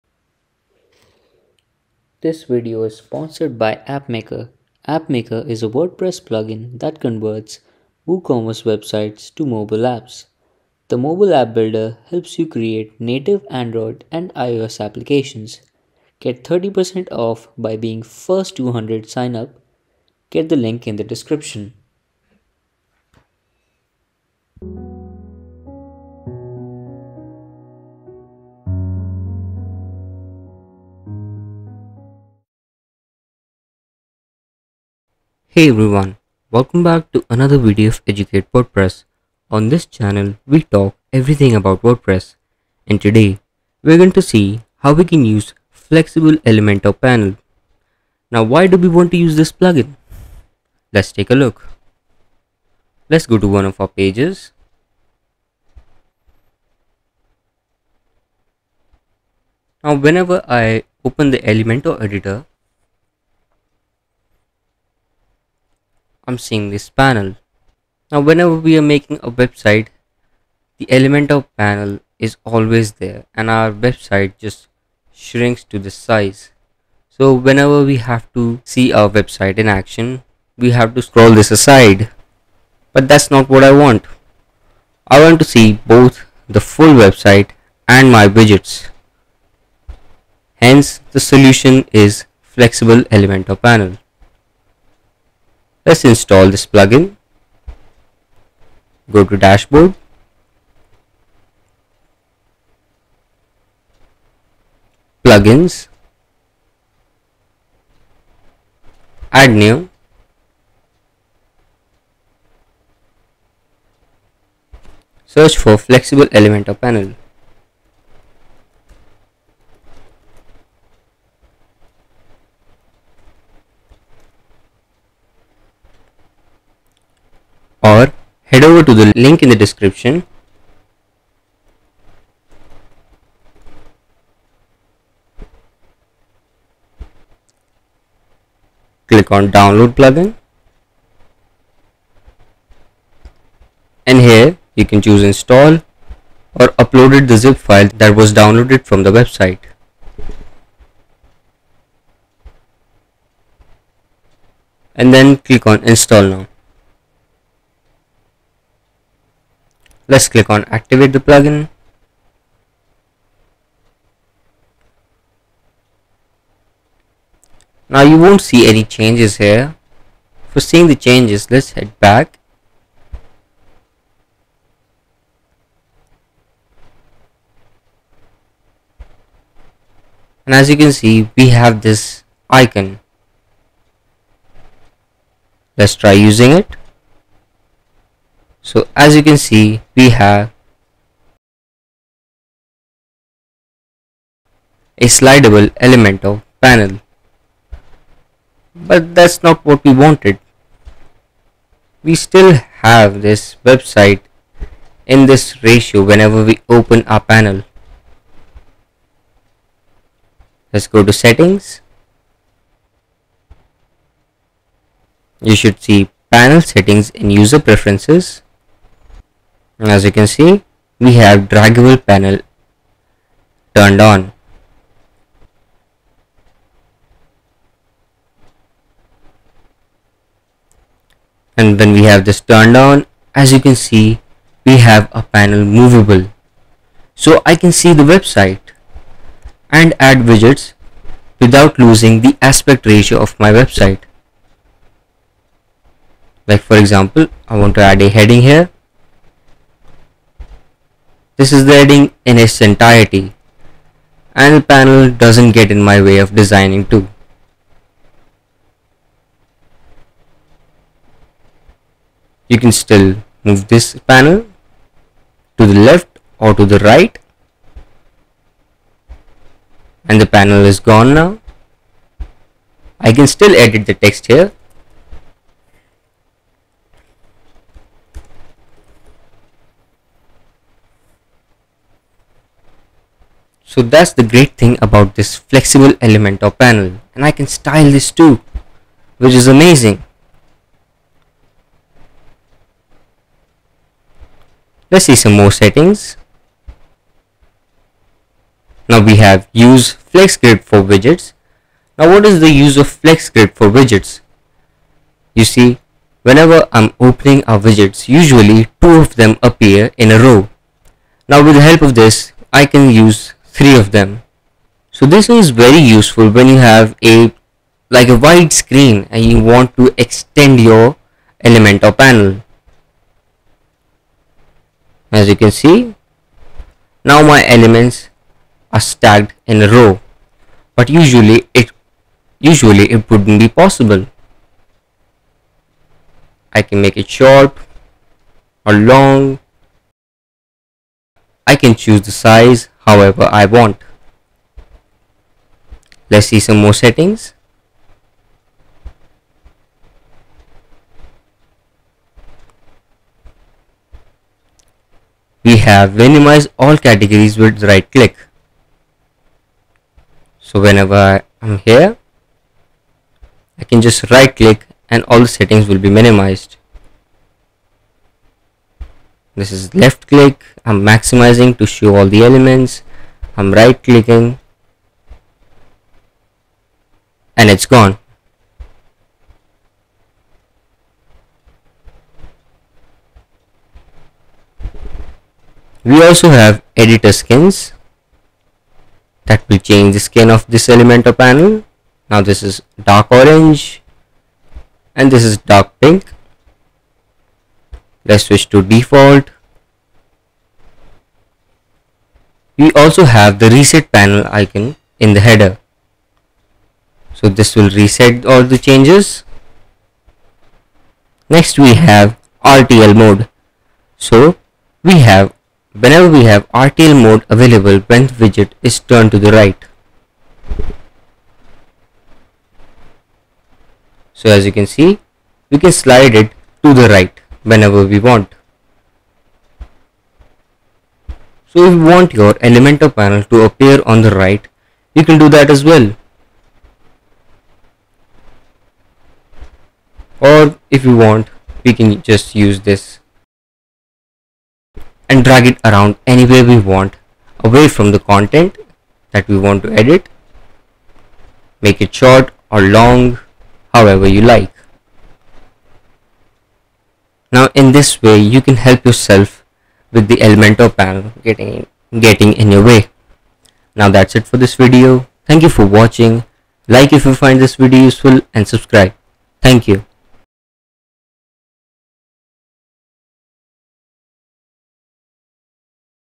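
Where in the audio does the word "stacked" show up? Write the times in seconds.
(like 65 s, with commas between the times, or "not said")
328 s.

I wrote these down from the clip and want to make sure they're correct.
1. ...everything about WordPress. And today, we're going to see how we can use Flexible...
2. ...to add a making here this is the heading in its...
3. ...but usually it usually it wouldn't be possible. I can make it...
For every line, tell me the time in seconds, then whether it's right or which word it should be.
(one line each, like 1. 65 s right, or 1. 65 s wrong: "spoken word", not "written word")
1. 41 s right
2. 247 s wrong: "heading", not "making"
3. 330 s right.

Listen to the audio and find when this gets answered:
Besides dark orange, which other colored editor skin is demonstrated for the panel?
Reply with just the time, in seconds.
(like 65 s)
395 s.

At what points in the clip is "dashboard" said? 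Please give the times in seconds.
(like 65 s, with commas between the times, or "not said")
99 s.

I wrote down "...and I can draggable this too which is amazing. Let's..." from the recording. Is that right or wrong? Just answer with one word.
wrong.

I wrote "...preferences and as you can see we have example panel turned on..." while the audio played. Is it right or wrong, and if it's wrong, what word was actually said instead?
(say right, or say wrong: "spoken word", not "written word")
wrong: "draggable", not "example".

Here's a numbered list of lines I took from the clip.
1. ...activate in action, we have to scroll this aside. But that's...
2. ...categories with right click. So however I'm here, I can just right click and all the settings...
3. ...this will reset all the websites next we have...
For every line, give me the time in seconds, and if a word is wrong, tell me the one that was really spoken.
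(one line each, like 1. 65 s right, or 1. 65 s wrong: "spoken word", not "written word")
1. 79 s wrong: "website", not "activate"
2. 356 s wrong: "whenever", not "however"
3. 407 s wrong: "changes", not "websites".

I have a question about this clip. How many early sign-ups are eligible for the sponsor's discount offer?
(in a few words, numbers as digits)
200.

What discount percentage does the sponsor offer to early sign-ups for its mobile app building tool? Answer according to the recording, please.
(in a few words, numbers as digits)
30%.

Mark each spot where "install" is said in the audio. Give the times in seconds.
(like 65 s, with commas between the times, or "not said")
96 s, 145 s, 155 s.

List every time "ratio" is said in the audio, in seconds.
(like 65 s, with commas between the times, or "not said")
205 s, 242 s.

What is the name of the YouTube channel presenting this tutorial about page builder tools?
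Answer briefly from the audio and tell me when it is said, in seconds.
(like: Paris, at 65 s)
Educate WordPress, at 38 s.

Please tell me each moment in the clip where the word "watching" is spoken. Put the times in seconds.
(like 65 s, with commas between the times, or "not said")
465 s.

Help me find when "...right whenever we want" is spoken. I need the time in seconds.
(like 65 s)
426 s.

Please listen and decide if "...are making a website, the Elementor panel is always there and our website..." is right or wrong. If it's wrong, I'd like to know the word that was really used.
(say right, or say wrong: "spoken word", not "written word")
right.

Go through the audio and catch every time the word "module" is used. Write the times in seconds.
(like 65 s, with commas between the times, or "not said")
not said.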